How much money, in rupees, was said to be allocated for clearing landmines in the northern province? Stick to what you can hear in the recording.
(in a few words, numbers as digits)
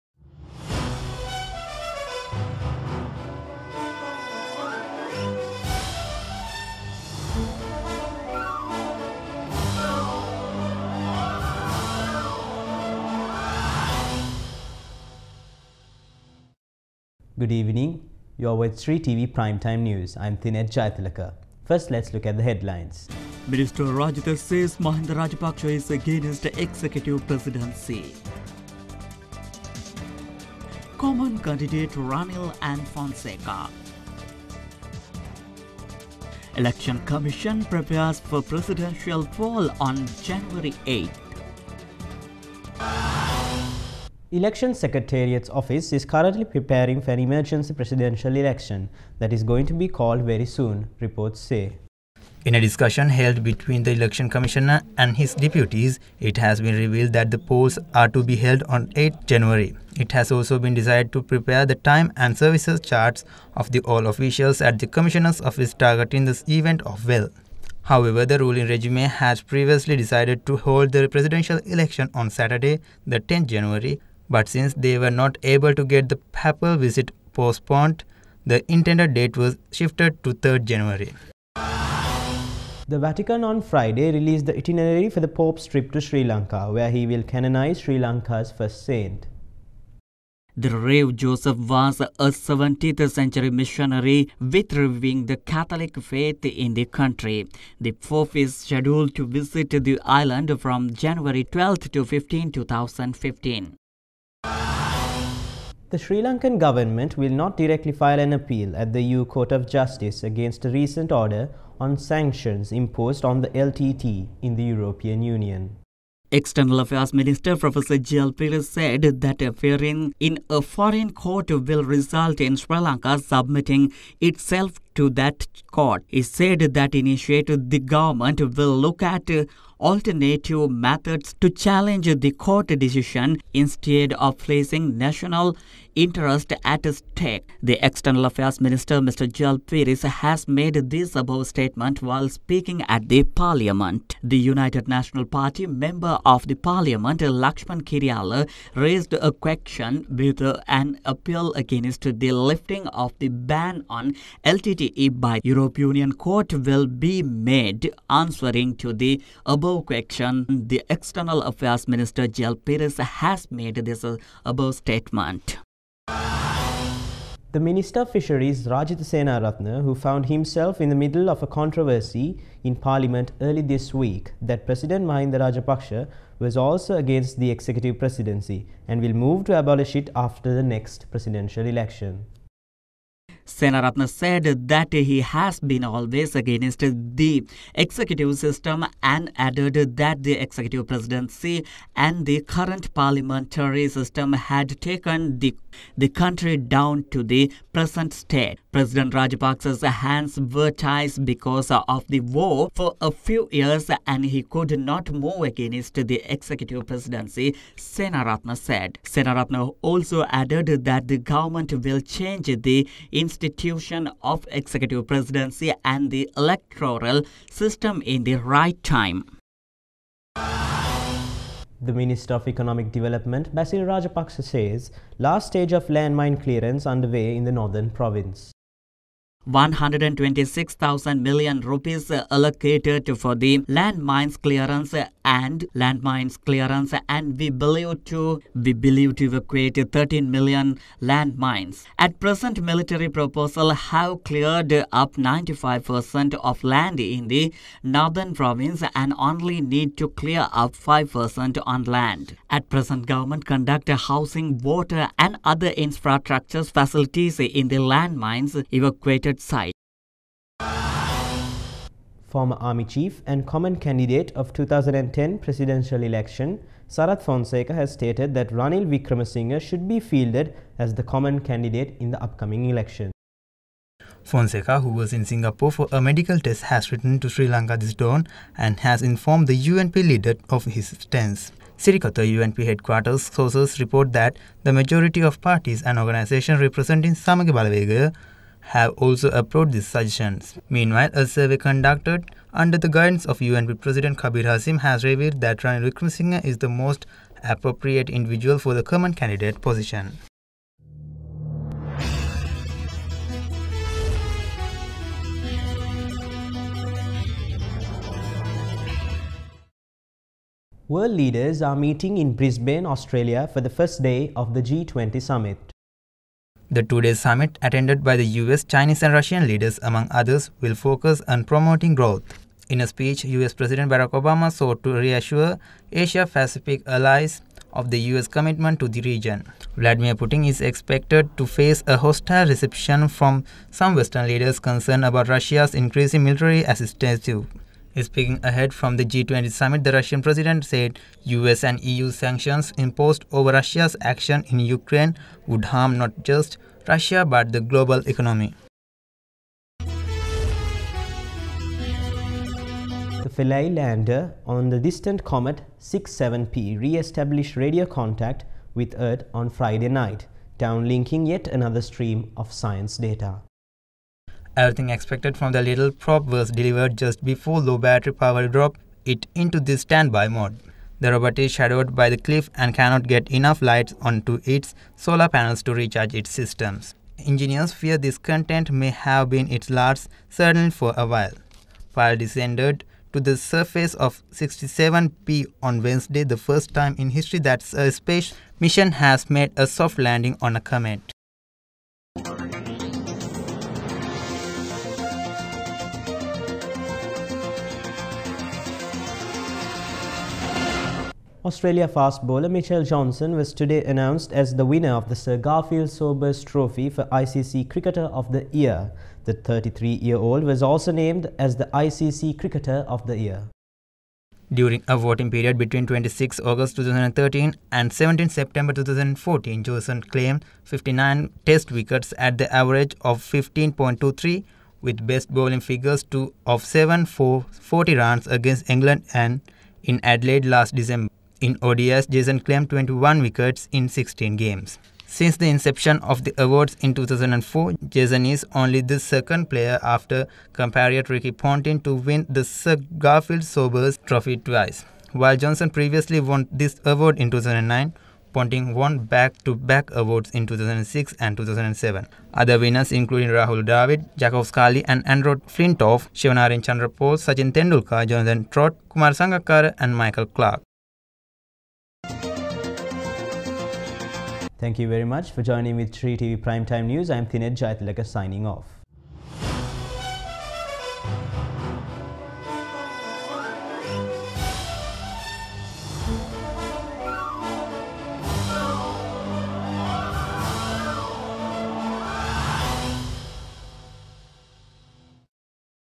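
126,000 million rupees.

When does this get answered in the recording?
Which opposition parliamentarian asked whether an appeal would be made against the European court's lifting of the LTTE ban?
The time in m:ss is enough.
2:27.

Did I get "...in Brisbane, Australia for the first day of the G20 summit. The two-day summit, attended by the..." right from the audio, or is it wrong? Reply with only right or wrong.
right.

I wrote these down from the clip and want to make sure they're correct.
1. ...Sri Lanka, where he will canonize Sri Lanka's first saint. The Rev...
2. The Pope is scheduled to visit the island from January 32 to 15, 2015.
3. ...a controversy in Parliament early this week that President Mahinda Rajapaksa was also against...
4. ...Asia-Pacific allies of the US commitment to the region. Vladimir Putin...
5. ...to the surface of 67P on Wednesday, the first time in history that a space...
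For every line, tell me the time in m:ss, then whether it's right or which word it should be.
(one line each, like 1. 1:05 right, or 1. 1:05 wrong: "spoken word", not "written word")
1. 1:26 right
2. 1:37 wrong: "12", not "32"
3. 2:51 right
4. 5:25 right
5. 6:23 right.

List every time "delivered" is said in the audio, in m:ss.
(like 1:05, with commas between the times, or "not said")
6:06.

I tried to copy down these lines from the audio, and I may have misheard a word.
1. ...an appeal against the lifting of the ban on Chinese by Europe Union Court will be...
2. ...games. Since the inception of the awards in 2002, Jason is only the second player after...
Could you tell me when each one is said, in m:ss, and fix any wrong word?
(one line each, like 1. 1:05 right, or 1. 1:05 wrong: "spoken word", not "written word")
1. 2:30 wrong: "LTTE", not "Chinese"
2. 7:14 wrong: "2004", not "2002".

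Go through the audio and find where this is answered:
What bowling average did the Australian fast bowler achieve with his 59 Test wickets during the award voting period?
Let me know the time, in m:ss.
7:03.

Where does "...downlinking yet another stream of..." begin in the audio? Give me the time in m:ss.
6:00.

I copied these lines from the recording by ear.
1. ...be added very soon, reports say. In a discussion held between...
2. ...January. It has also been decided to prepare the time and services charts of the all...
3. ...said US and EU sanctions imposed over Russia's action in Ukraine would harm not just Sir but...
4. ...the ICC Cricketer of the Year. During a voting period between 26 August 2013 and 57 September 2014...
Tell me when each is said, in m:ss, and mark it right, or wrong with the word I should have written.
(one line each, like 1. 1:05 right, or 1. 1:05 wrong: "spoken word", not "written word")
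1. 0:49 wrong: "called", not "added"
2. 0:59 right
3. 5:40 wrong: "Russia", not "Sir"
4. 6:51 wrong: "17", not "57".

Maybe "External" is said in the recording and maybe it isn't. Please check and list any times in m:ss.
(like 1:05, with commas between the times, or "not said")
1:56, 2:17, 2:40.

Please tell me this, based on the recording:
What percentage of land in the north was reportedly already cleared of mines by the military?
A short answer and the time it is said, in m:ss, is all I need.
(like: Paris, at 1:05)
95%, at 4:05.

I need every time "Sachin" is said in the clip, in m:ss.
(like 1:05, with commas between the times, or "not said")
7:37.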